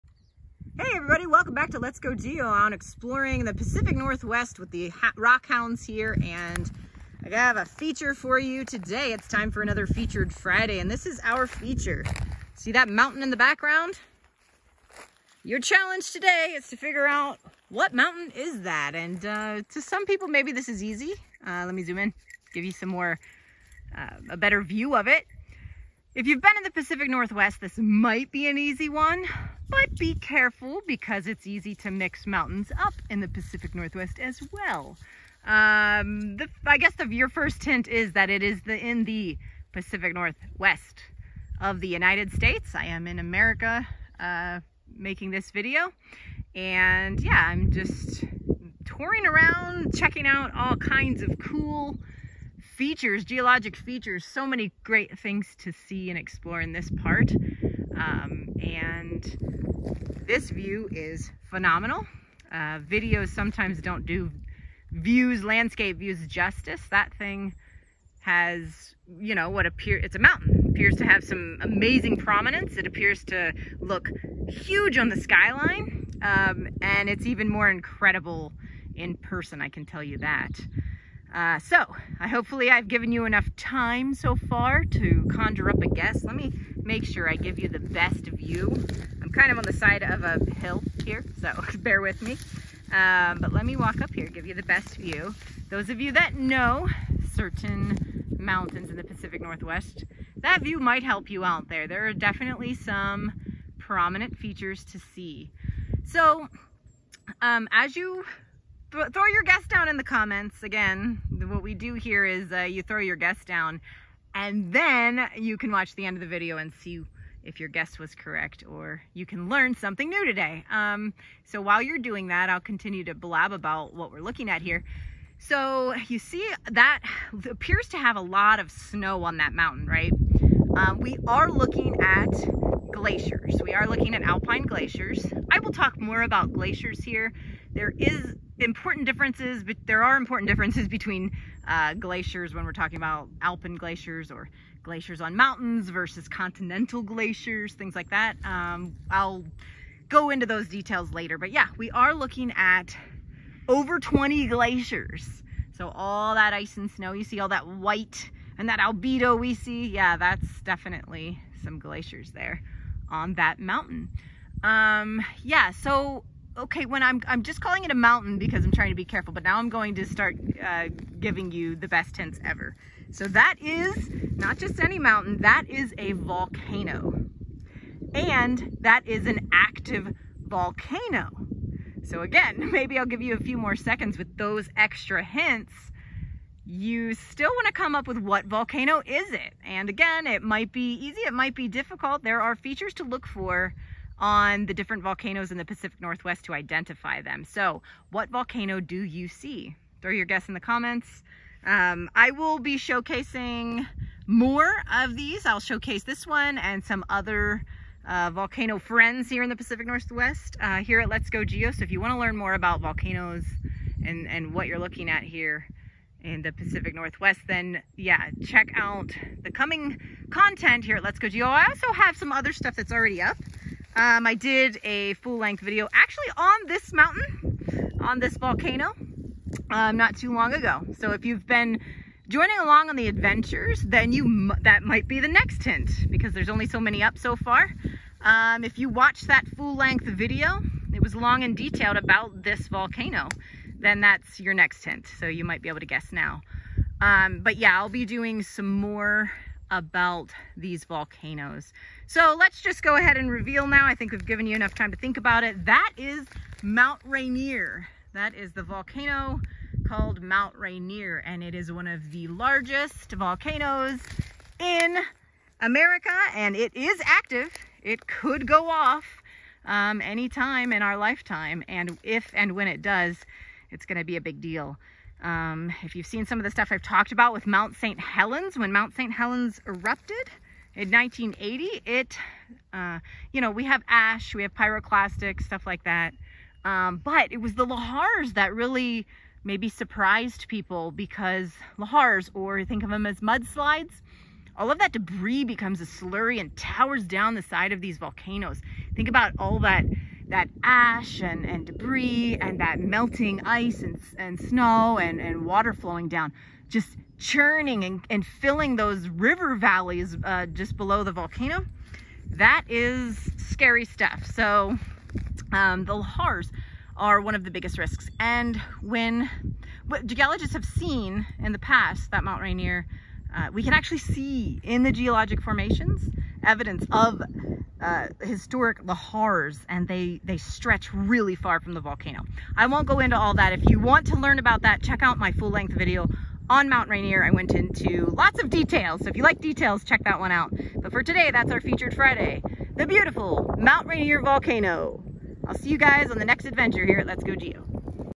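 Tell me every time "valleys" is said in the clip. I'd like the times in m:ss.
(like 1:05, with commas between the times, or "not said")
5:09.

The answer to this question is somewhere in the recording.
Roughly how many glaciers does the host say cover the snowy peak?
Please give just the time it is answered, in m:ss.
2:33.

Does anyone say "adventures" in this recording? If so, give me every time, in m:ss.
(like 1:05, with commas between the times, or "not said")
3:53, 5:46.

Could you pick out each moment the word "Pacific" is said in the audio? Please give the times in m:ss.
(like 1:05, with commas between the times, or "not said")
0:03, 0:26, 0:33, 0:39, 1:39, 3:15, 3:29, 3:36.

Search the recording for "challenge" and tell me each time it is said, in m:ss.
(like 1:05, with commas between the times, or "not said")
0:15.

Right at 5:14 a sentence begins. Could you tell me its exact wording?
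So um, the lahars are one of the biggest risks.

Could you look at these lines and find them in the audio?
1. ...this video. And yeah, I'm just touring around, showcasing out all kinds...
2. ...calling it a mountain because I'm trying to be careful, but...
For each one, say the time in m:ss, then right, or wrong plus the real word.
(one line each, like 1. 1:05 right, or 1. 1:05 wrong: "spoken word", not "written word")
1. 0:45 wrong: "checking", not "showcasing"
2. 2:47 right.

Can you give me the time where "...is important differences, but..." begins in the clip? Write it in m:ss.
2:17.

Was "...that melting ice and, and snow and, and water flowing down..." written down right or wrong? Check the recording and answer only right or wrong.
right.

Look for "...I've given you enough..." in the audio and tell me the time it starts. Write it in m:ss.
1:22.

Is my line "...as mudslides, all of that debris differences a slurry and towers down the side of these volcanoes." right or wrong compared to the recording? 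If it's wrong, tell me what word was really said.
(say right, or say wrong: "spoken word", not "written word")
wrong: "becomes", not "differences".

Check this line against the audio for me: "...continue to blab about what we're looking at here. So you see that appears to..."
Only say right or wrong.
right.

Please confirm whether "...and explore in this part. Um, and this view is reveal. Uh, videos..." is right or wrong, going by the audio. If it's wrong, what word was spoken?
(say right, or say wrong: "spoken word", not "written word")
wrong: "phenomenal", not "reveal".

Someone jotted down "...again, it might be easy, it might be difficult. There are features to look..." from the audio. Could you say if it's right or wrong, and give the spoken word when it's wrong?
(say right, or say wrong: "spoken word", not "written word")
right.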